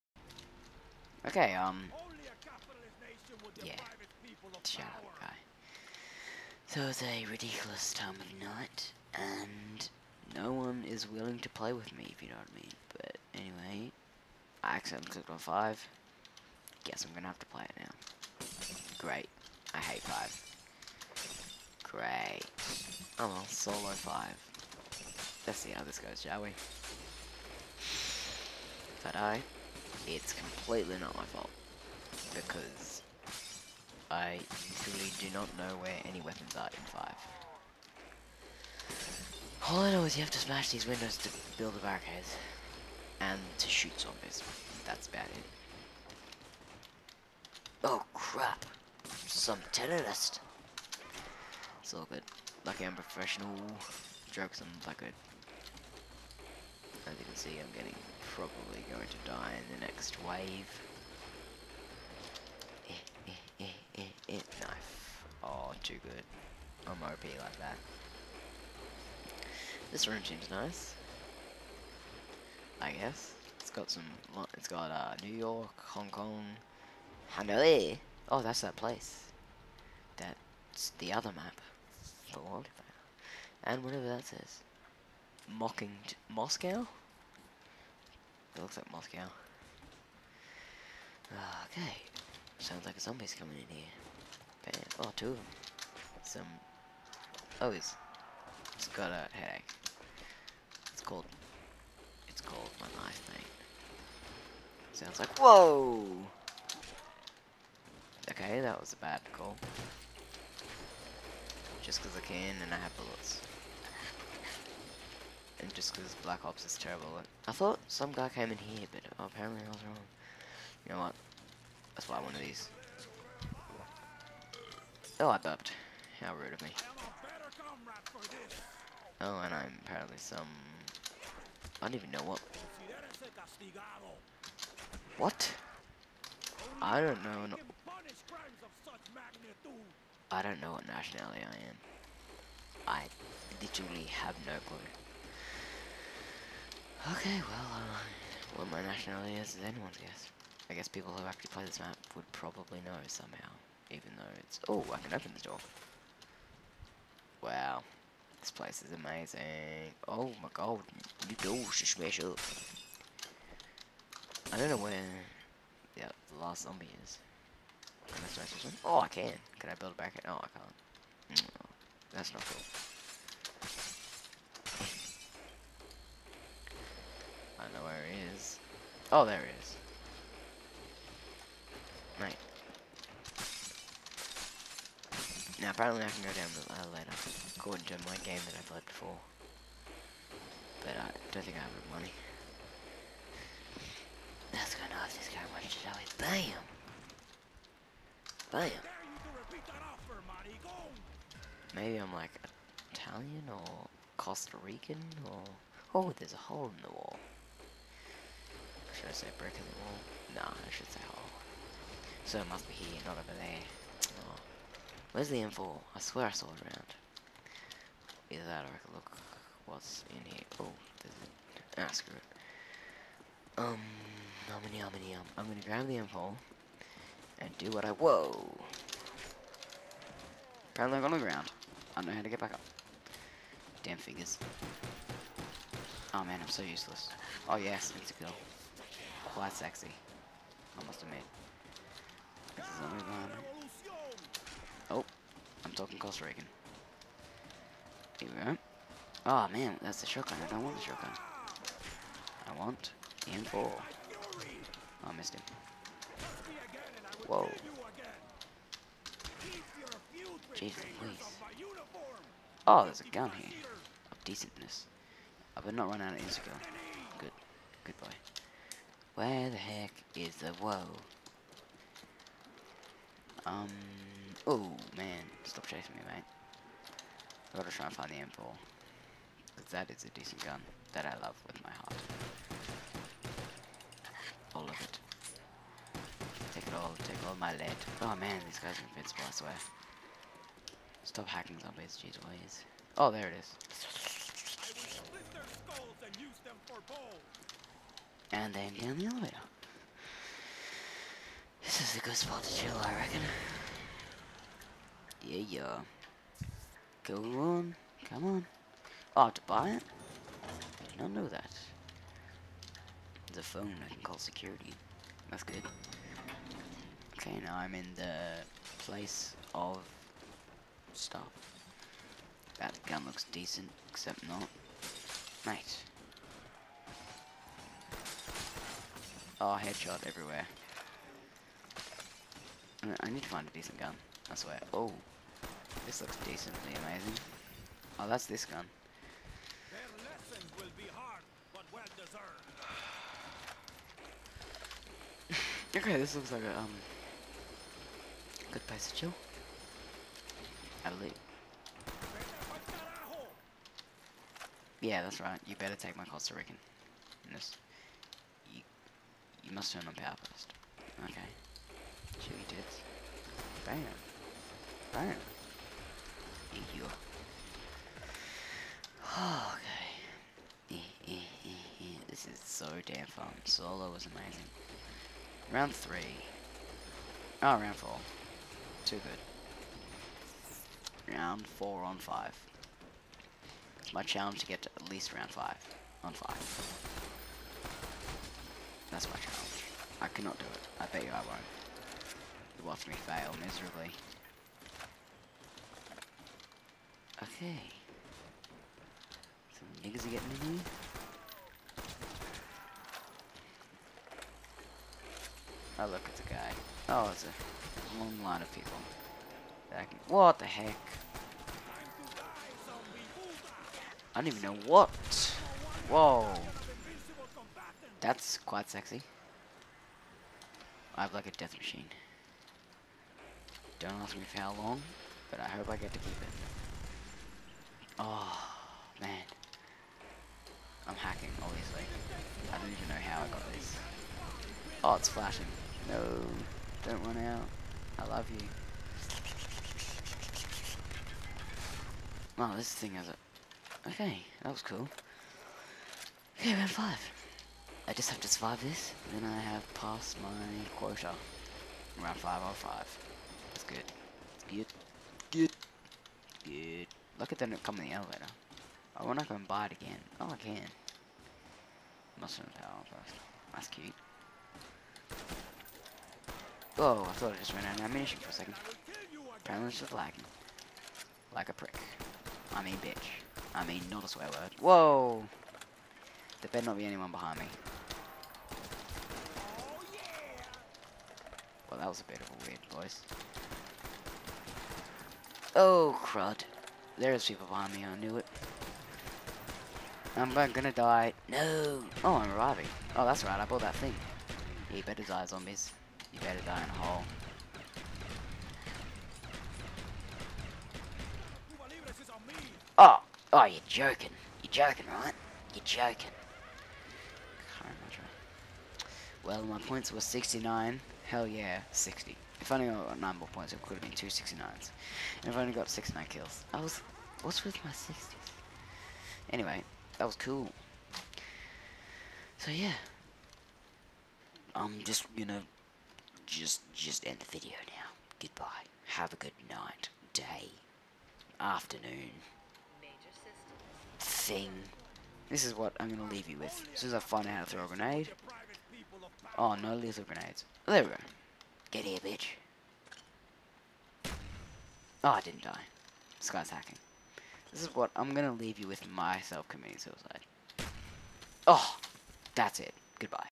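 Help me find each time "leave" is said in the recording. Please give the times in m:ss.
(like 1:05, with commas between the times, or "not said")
8:56, 9:08.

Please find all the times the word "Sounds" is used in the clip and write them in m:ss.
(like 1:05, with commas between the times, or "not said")
1:32, 1:44.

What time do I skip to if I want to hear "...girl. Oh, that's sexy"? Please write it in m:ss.
3:58.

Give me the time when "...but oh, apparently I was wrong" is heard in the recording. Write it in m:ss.
1:58.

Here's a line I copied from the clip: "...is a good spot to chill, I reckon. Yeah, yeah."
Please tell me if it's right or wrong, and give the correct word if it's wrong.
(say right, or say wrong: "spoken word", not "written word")
right.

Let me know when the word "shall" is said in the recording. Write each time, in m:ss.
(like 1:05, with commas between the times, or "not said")
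0:26, 3:15.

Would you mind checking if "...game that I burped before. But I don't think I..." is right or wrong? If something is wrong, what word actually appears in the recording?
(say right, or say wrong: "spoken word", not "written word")
wrong: "played", not "burped".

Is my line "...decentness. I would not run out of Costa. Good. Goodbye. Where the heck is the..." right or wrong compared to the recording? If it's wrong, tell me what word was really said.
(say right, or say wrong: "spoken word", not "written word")
wrong: "Instagram", not "Costa".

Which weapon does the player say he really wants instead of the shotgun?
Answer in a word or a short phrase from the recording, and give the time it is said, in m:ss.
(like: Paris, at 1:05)
M4, at 4:12.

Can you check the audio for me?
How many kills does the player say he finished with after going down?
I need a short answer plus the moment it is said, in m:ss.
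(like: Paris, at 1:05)
69, at 8:35.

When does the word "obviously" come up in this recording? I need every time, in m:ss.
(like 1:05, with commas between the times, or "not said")
7:11.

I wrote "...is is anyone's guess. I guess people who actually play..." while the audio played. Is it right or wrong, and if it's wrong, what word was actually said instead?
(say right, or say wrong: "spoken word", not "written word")
right.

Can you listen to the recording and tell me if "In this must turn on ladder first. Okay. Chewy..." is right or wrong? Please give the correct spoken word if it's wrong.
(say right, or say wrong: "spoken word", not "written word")
wrong: "power", not "ladder".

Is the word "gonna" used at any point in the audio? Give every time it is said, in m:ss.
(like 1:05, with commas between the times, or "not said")
0:17, 3:14, 3:45, 8:10, 8:45, 8:55.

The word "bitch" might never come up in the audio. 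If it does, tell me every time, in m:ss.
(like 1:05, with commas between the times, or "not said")
7:52, 9:02.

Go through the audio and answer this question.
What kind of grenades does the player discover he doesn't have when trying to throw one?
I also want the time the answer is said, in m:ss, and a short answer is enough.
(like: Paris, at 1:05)
lethal grenades, at 8:59.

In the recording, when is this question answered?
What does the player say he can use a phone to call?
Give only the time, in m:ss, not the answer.
5:13.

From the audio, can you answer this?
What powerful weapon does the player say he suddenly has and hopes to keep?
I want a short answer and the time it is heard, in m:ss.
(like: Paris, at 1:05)
death machine, at 7:01.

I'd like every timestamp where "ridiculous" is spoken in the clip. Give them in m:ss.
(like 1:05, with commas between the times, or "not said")
0:07.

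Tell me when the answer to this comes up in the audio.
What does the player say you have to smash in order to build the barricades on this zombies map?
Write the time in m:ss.
0:40.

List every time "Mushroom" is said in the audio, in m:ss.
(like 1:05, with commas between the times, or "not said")
7:42.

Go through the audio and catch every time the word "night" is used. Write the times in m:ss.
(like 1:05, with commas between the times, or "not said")
0:08, 8:49.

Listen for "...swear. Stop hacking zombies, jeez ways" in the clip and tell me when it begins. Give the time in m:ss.
4:49.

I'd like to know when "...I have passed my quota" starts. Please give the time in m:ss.
7:29.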